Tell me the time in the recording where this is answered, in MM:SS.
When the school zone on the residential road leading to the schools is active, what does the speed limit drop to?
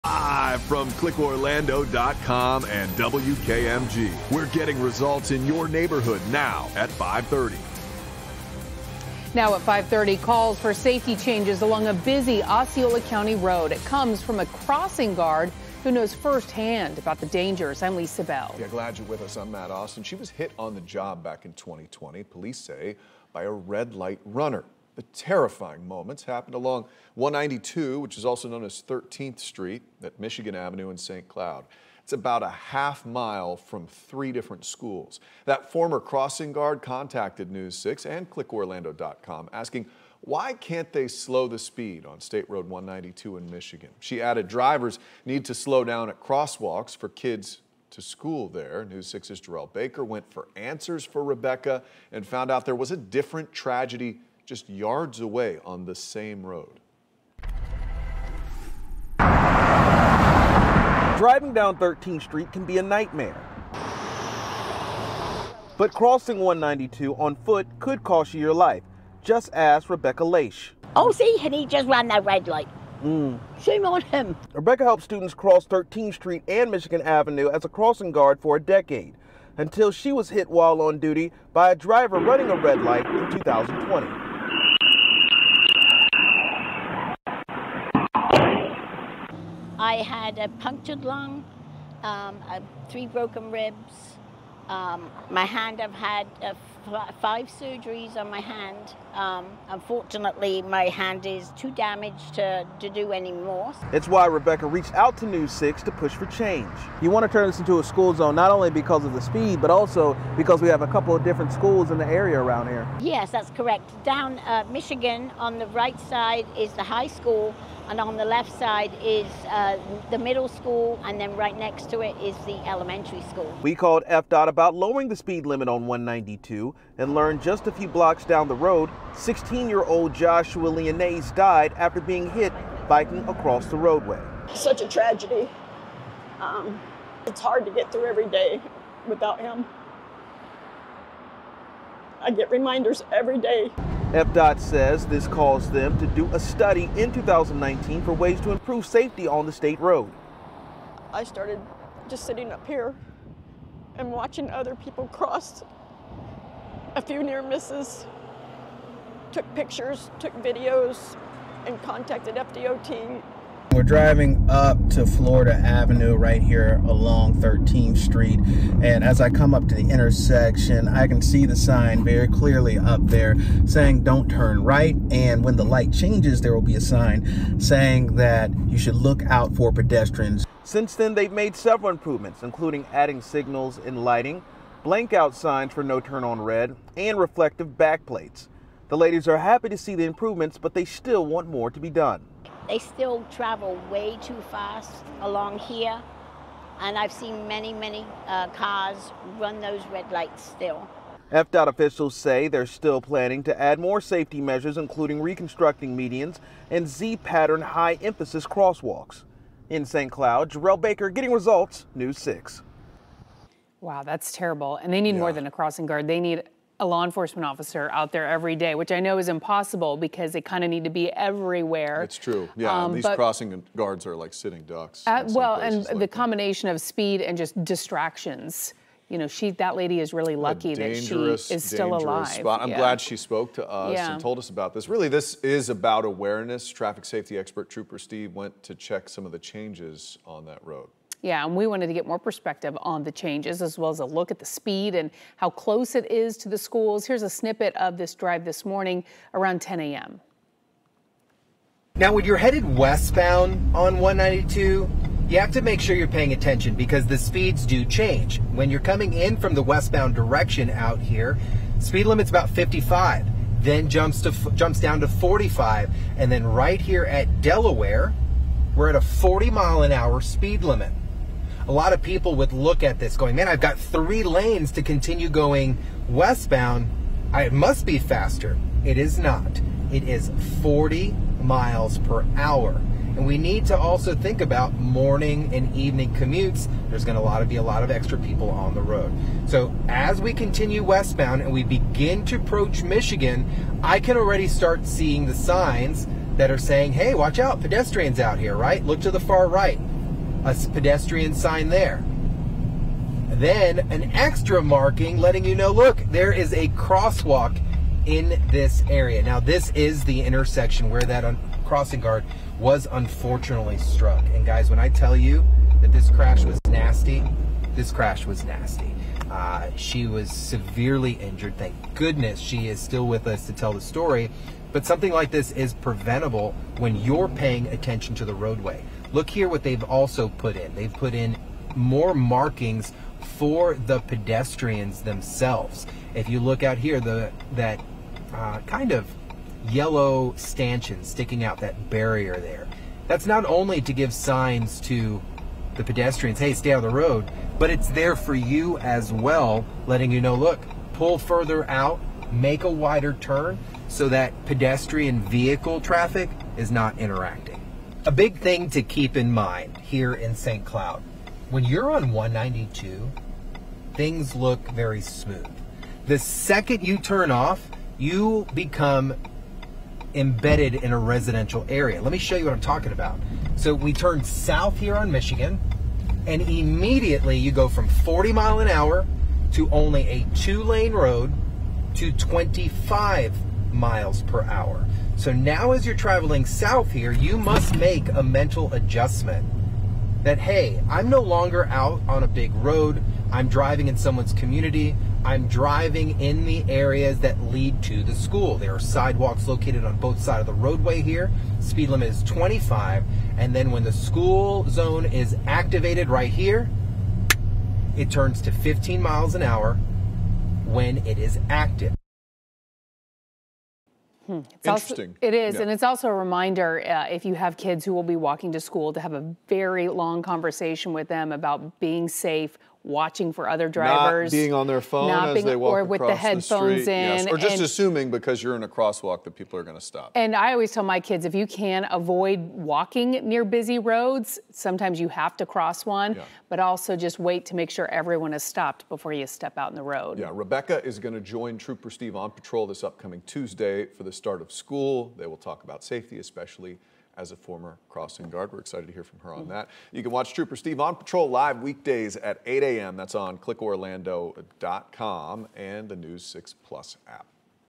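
06:48.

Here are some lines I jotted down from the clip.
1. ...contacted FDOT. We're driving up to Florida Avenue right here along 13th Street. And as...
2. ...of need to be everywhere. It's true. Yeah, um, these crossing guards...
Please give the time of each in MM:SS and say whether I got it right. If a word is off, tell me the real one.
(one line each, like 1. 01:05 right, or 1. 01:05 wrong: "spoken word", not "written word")
1. 02:41 right
2. 03:40 right.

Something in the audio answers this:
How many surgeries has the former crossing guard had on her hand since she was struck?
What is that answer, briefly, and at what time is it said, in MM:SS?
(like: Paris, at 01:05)
5, at 01:37.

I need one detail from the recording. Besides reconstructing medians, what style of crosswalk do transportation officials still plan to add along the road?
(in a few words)
Z pattern high emphasis.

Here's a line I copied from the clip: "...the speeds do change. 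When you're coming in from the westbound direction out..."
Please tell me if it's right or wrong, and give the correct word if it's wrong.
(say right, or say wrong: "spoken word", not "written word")
right.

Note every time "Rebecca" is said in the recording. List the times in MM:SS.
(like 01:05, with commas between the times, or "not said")
00:51, 01:09, 01:14, 01:44, 07:20.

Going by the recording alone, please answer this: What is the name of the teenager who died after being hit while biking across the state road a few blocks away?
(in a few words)
Joshua Leonese.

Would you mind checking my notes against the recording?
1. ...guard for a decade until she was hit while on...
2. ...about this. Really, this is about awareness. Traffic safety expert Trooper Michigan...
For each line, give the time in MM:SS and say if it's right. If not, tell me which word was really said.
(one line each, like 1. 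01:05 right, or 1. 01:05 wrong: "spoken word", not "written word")
1. 01:18 right
2. 03:54 wrong: "Steve", not "Michigan".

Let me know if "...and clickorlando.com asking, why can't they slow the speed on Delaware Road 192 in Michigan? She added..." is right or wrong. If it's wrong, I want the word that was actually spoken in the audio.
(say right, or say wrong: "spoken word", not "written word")
wrong: "State", not "Delaware".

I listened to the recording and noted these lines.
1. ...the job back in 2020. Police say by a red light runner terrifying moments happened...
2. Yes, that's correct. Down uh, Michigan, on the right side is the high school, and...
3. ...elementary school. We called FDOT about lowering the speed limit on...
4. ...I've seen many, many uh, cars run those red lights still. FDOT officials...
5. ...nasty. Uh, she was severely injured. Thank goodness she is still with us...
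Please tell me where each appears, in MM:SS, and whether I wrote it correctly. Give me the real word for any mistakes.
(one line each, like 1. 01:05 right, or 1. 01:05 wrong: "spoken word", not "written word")
1. 00:20 right
2. 01:52 right
3. 02:02 right
4. 03:16 right
5. 05:18 right.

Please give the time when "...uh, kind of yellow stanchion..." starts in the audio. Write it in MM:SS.
05:38.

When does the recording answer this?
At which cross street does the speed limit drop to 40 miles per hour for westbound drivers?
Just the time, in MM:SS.
04:27.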